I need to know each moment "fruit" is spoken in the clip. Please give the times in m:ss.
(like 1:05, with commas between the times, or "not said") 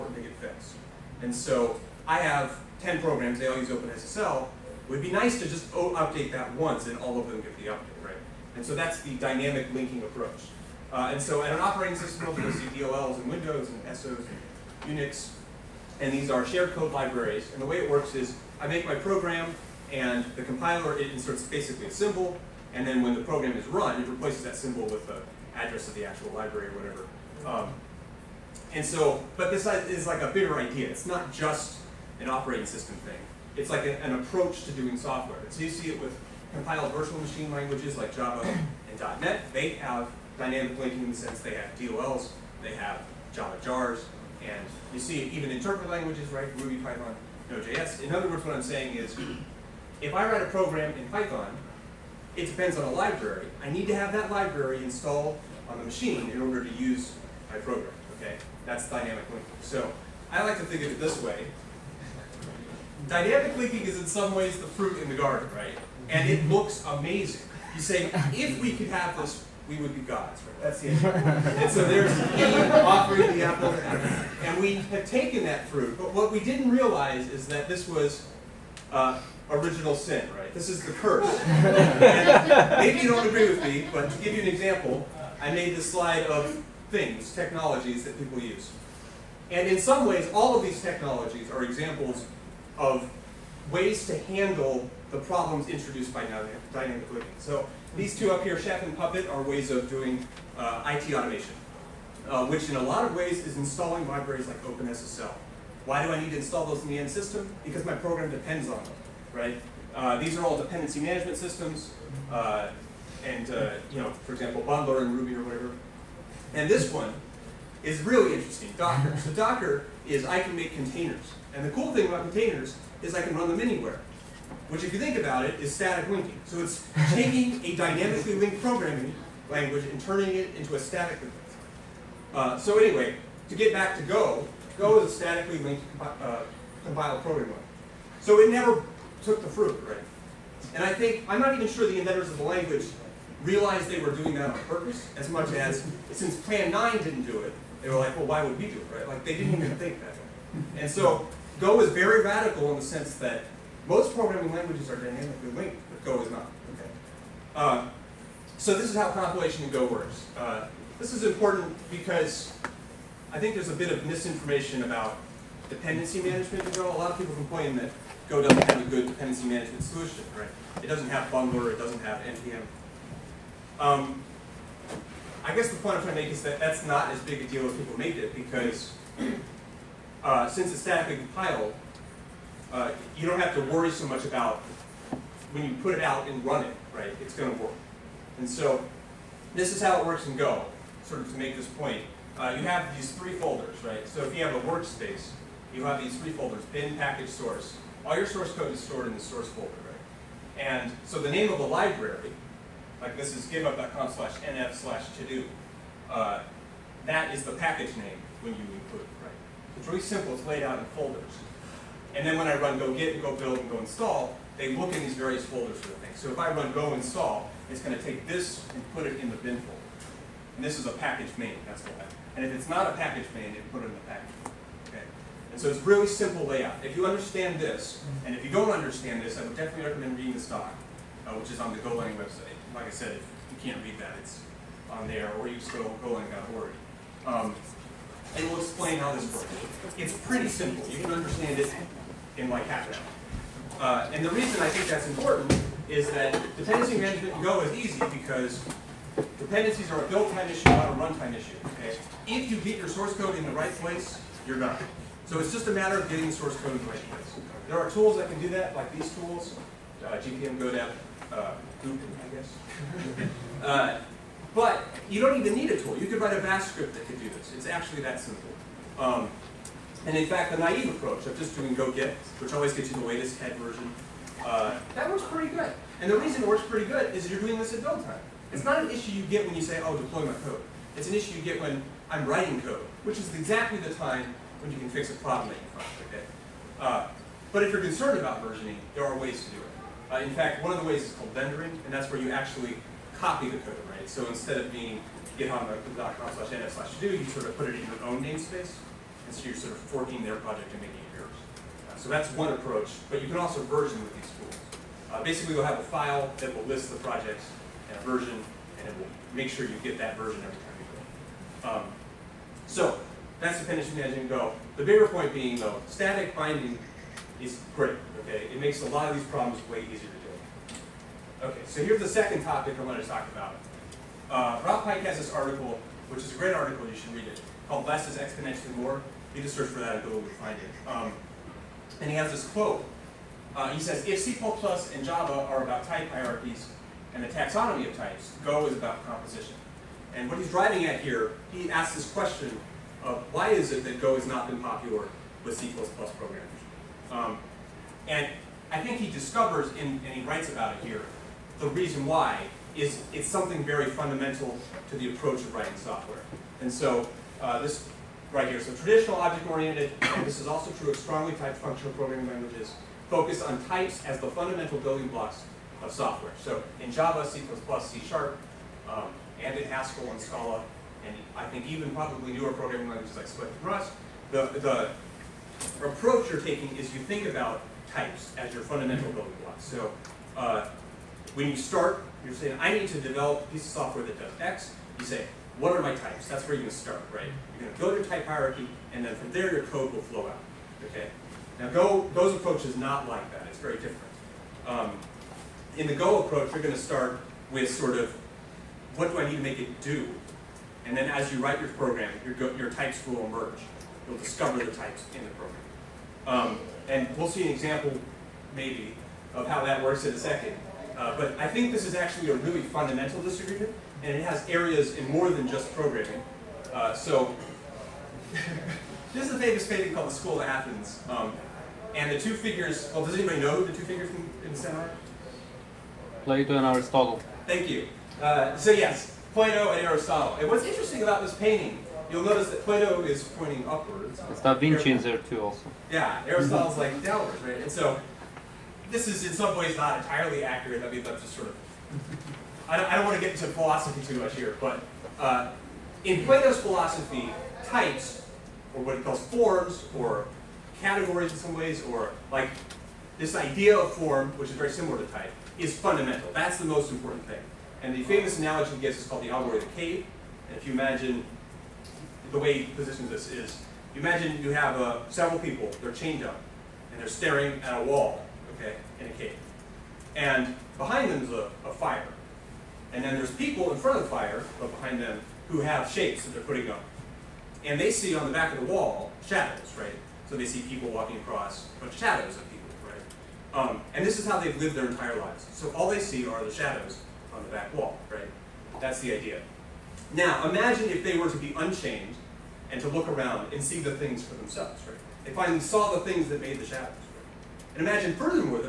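1:04, 1:15, 2:19.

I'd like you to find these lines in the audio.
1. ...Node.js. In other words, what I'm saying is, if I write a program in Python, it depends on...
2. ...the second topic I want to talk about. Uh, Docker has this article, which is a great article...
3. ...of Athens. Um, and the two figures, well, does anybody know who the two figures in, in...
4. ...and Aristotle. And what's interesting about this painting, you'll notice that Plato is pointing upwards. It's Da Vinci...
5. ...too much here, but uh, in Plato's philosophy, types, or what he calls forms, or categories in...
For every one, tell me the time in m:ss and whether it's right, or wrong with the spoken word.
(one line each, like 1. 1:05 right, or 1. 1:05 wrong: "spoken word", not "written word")
1. 0:47 right
2. 5:22 wrong: "Pike", not "Docker"
3. 7:00 right
4. 7:09 right
5. 7:24 right.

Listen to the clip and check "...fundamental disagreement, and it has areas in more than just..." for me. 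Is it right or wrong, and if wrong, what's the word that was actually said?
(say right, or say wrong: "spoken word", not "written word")
right.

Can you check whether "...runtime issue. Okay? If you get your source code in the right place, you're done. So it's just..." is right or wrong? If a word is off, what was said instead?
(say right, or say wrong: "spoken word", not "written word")
right.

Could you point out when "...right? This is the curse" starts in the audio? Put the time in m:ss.
1:20.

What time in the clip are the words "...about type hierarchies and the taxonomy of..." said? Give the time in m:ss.
5:35.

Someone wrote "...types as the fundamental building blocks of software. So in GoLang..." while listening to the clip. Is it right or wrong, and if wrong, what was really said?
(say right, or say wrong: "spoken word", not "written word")
wrong: "Java", not "GoLang".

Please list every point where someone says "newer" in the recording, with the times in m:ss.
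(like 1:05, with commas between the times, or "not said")
6:12.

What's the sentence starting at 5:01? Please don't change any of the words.
Uh, so that's one approach, but you can also version with these tools.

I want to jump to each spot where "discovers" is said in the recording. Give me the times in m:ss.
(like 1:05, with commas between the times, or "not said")
5:49, 6:44.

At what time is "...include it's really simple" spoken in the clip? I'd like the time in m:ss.
3:28.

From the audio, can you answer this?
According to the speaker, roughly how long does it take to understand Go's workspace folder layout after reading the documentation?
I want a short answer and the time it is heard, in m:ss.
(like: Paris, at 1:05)
half an hour, at 4:02.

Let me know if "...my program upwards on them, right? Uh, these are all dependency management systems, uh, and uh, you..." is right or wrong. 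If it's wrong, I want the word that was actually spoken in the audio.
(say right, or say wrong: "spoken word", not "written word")
wrong: "depends", not "upwards".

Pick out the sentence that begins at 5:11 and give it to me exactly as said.
Um, so that's dependency management go.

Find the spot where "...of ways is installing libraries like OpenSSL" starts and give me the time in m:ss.
1:43.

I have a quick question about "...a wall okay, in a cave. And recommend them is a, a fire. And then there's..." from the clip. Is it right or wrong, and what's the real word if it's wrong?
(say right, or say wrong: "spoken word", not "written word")
wrong: "behind", not "recommend".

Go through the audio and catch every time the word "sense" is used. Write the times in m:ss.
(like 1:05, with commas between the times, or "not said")
0:41, 2:32.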